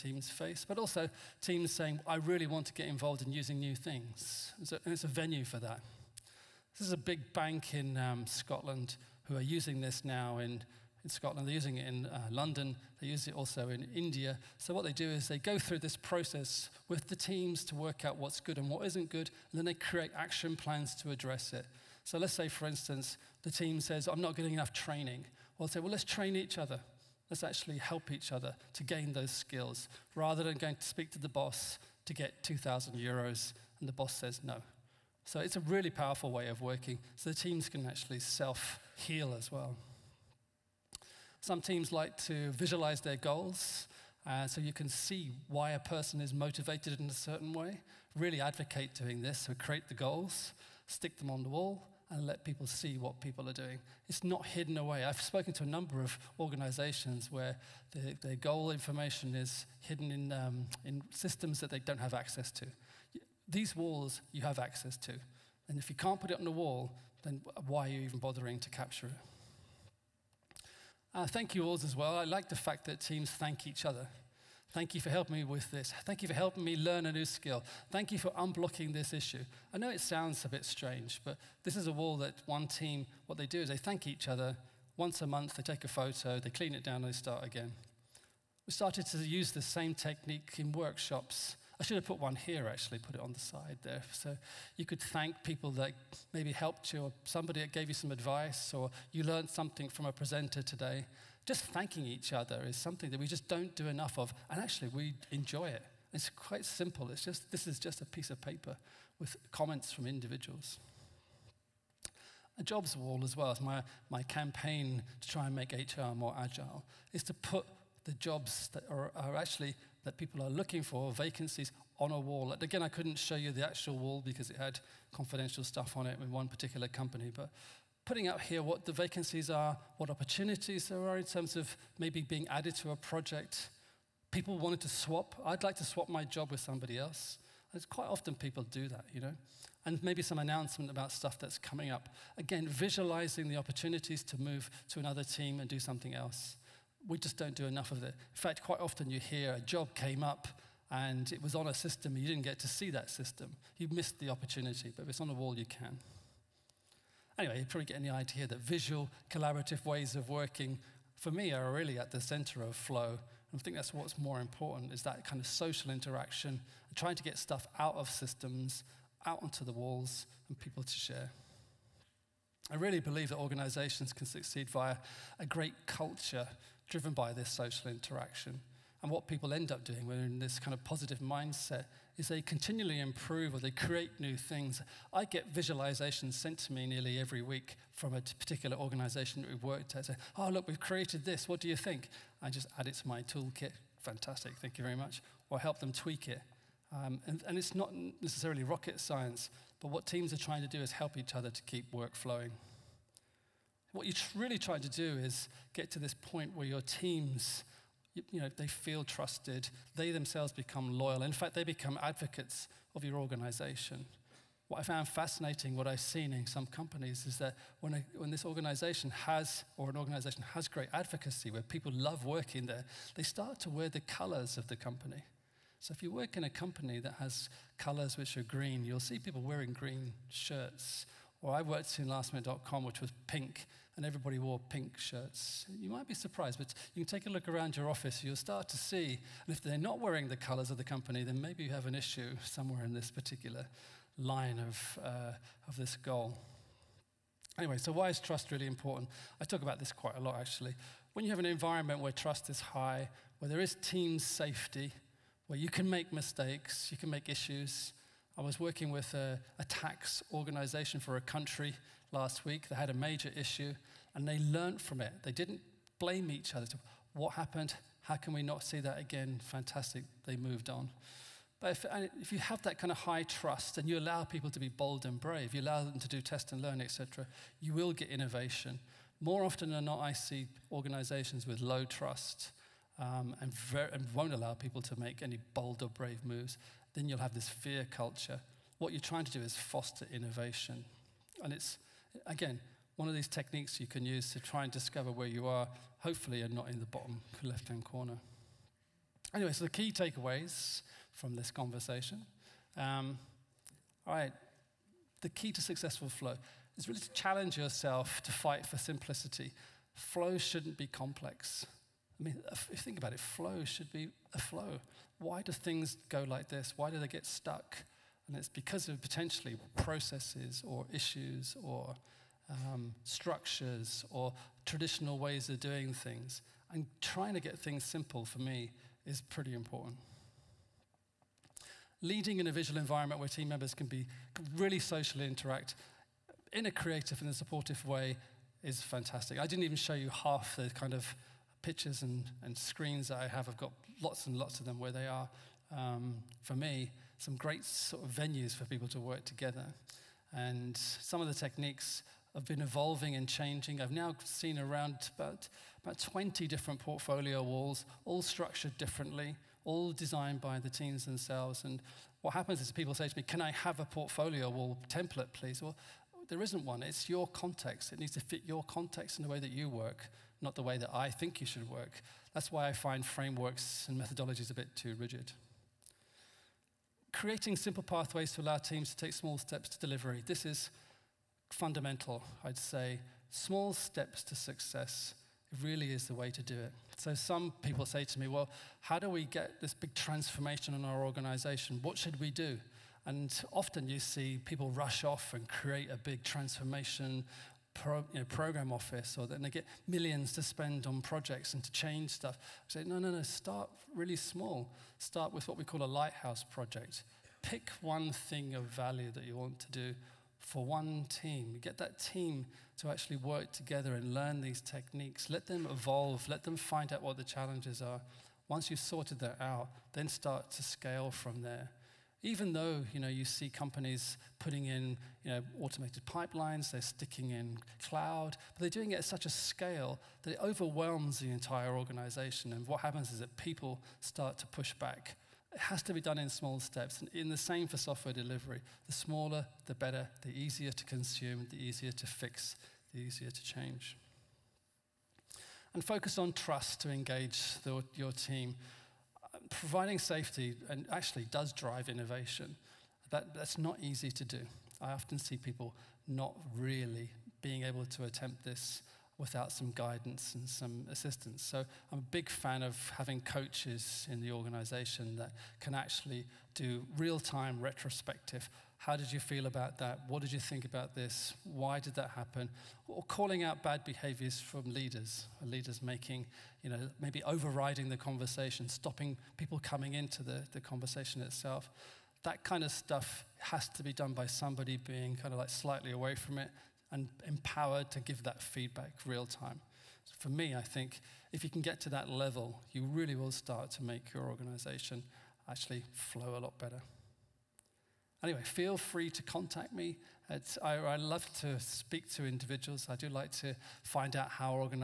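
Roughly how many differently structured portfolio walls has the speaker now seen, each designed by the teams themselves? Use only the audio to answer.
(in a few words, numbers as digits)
20.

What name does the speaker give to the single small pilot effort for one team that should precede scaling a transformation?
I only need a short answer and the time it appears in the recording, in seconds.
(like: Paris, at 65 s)
Lighthouse project, at 405 s.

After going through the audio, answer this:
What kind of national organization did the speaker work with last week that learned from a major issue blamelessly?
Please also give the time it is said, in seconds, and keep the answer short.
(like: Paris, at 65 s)
Tax organization, at 259 s.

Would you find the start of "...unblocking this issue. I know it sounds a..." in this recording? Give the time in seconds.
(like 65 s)
78 s.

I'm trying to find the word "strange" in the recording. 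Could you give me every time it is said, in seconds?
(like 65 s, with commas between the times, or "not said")
80 s.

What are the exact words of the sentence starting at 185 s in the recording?
I get visualizations sent to me nearly every week from a particular organization that we've worked at.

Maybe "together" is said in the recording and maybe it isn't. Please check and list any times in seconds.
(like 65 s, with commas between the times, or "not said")
349 s, 413 s.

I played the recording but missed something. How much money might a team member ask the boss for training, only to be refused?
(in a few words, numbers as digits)
2,000 euros.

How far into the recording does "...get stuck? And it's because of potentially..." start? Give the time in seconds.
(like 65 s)
317 s.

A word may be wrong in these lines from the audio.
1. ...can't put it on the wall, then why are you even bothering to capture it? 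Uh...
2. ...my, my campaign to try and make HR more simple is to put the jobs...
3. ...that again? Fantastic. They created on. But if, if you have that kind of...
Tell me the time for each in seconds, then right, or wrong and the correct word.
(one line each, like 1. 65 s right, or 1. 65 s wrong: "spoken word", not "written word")
1. 65 s right
2. 113 s wrong: "agile", not "simple"
3. 268 s wrong: "moved", not "created".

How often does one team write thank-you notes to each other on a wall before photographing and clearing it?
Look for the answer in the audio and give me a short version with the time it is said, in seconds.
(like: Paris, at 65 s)
Once a month, at 84 s.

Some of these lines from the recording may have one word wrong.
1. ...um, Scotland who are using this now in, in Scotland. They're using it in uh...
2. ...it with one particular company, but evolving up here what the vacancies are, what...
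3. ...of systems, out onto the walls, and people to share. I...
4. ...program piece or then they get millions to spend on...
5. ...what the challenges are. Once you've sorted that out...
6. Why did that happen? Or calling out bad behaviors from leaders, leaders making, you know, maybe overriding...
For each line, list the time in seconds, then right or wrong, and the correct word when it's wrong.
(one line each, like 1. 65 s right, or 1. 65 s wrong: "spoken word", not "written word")
1. 7 s right
2. 126 s wrong: "putting", not "evolving"
3. 167 s right
4. 398 s wrong: "office", not "piece"
5. 417 s right
6. 471 s right.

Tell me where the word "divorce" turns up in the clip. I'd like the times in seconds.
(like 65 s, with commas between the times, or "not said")
not said.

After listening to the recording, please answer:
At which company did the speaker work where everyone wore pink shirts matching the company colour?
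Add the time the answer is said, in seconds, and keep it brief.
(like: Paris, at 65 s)
lastminute.com, at 232 s.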